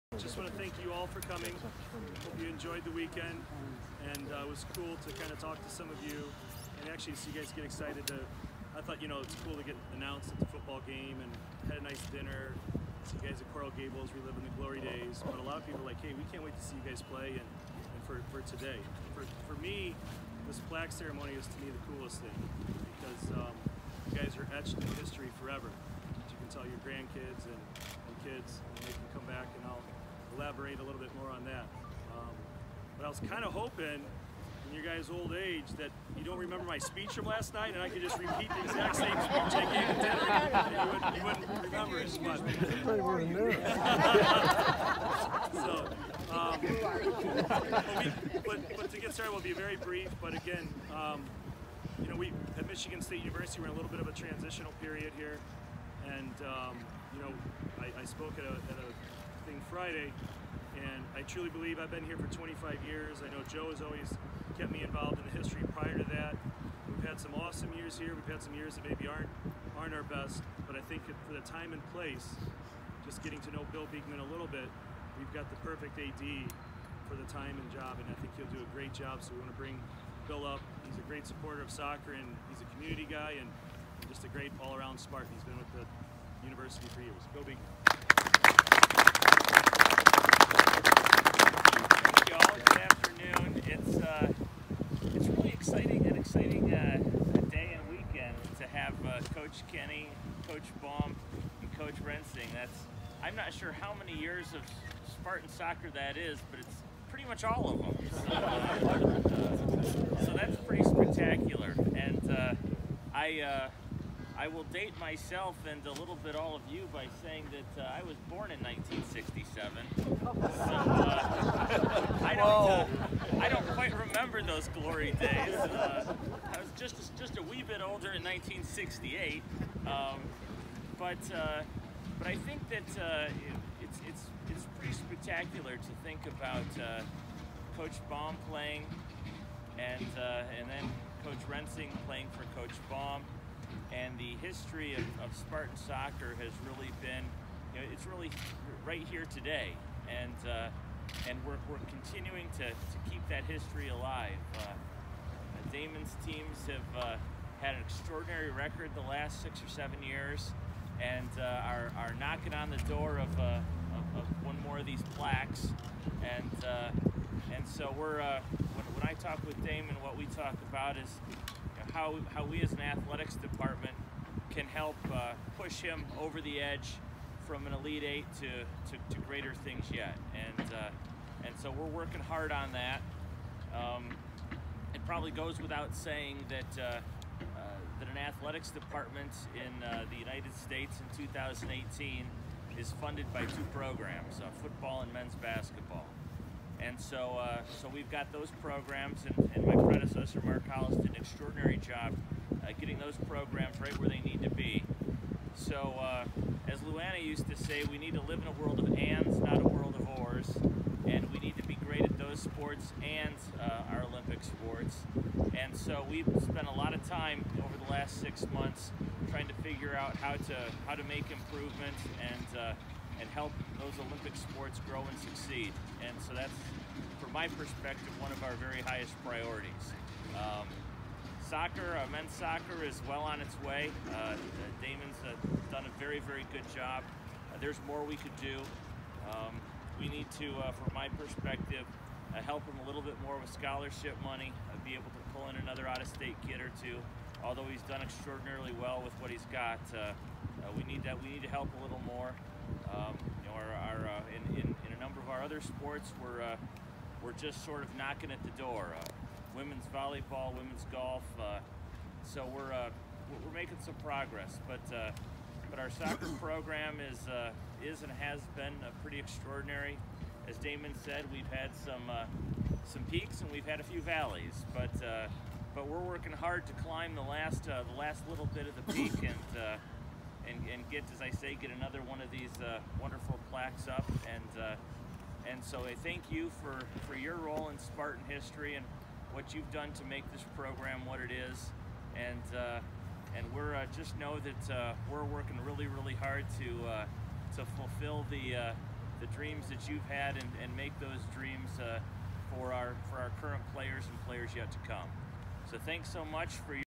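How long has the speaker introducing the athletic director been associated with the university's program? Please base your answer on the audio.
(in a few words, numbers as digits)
25 years.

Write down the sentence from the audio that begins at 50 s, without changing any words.
But again, um, you know, we at Michigan State University, we're in a little bit of a transitional period here.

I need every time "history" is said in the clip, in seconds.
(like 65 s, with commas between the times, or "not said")
25 s, 65 s, 144 s, 153 s, 288 s.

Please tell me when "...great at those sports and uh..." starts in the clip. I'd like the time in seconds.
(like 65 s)
211 s.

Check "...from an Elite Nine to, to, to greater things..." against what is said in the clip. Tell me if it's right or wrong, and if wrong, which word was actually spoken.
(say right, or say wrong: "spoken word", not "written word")
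wrong: "Eight", not "Nine".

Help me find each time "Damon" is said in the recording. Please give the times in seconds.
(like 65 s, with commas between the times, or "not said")
155 s, 169 s, 234 s, 270 s.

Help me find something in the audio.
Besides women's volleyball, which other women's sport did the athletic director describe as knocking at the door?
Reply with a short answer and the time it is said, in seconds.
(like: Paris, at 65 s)
women's golf, at 260 s.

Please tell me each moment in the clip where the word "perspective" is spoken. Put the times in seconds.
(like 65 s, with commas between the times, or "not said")
227 s, 241 s.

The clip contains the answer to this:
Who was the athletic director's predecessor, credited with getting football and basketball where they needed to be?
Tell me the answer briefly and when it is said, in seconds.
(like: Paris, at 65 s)
Mark Hollis, at 200 s.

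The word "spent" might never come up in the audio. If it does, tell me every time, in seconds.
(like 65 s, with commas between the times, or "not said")
216 s.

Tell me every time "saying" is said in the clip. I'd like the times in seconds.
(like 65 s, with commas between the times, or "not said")
117 s, 185 s.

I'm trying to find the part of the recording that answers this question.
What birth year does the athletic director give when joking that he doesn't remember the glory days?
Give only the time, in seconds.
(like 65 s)
118 s.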